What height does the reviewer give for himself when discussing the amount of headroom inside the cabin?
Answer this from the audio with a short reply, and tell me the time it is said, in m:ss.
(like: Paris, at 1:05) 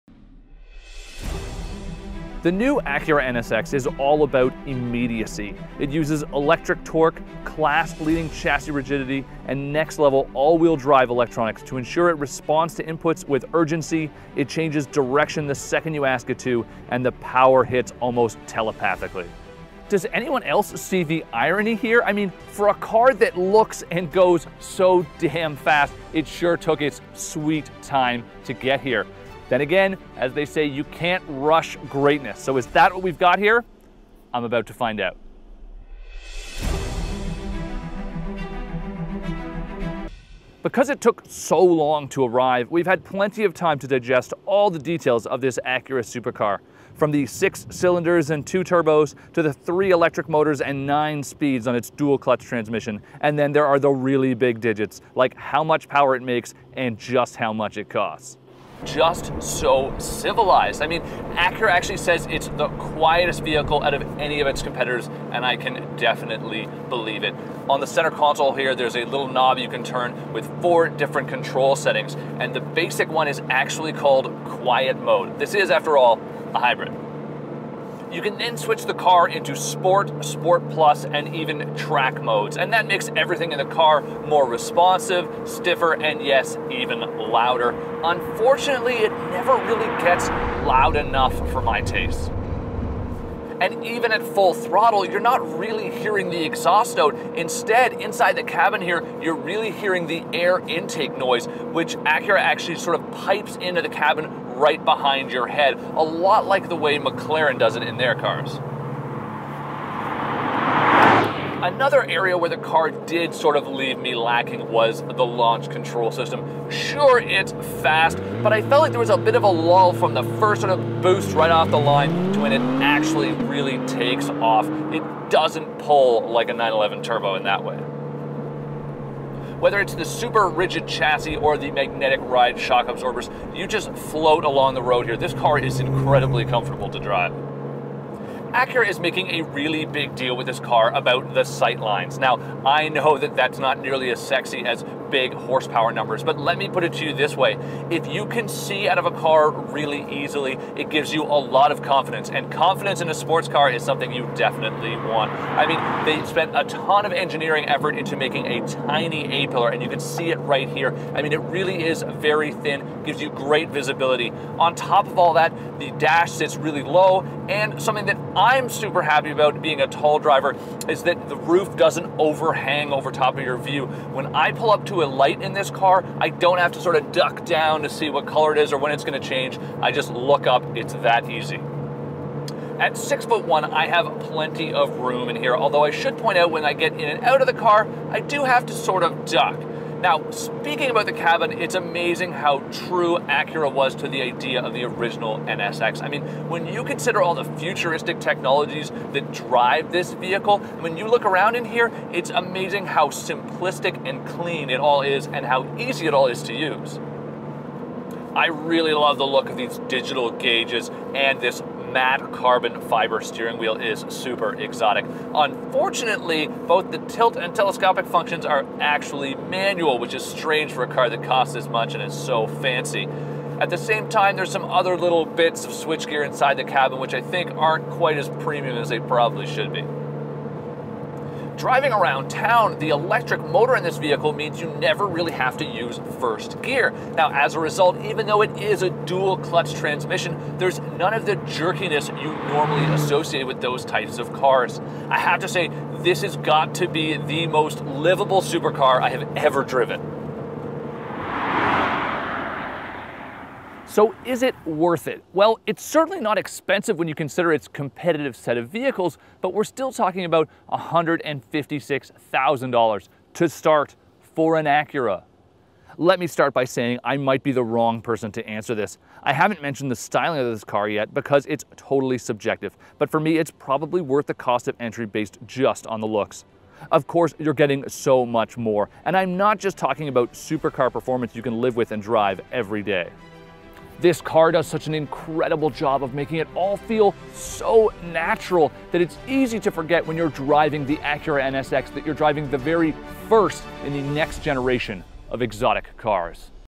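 6 foot 1, at 3:02.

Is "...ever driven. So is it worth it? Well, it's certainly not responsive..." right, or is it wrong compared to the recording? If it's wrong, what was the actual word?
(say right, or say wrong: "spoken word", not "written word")
wrong: "expensive", not "responsive".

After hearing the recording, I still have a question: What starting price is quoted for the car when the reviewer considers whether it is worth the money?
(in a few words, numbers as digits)
$156,000.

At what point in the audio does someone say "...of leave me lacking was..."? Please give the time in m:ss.
1:53.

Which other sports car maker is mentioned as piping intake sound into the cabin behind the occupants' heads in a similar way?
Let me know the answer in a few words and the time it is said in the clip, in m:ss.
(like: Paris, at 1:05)
McLaren, at 1:46.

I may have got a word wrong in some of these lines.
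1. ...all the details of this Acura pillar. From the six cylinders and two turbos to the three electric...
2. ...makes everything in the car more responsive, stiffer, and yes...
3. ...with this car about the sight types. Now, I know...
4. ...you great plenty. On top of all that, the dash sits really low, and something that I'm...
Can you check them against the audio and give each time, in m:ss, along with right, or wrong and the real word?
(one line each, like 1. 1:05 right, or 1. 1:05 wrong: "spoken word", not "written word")
1. 0:44 wrong: "supercar", not "pillar"
2. 1:22 right
3. 2:20 wrong: "lines", not "types"
4. 2:43 wrong: "visibility", not "plenty".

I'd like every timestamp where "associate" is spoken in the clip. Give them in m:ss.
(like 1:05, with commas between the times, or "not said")
4:02.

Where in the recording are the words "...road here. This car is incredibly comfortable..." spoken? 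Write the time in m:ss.
2:14.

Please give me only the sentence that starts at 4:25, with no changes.
Let me start by saying I might be the wrong person to answer this.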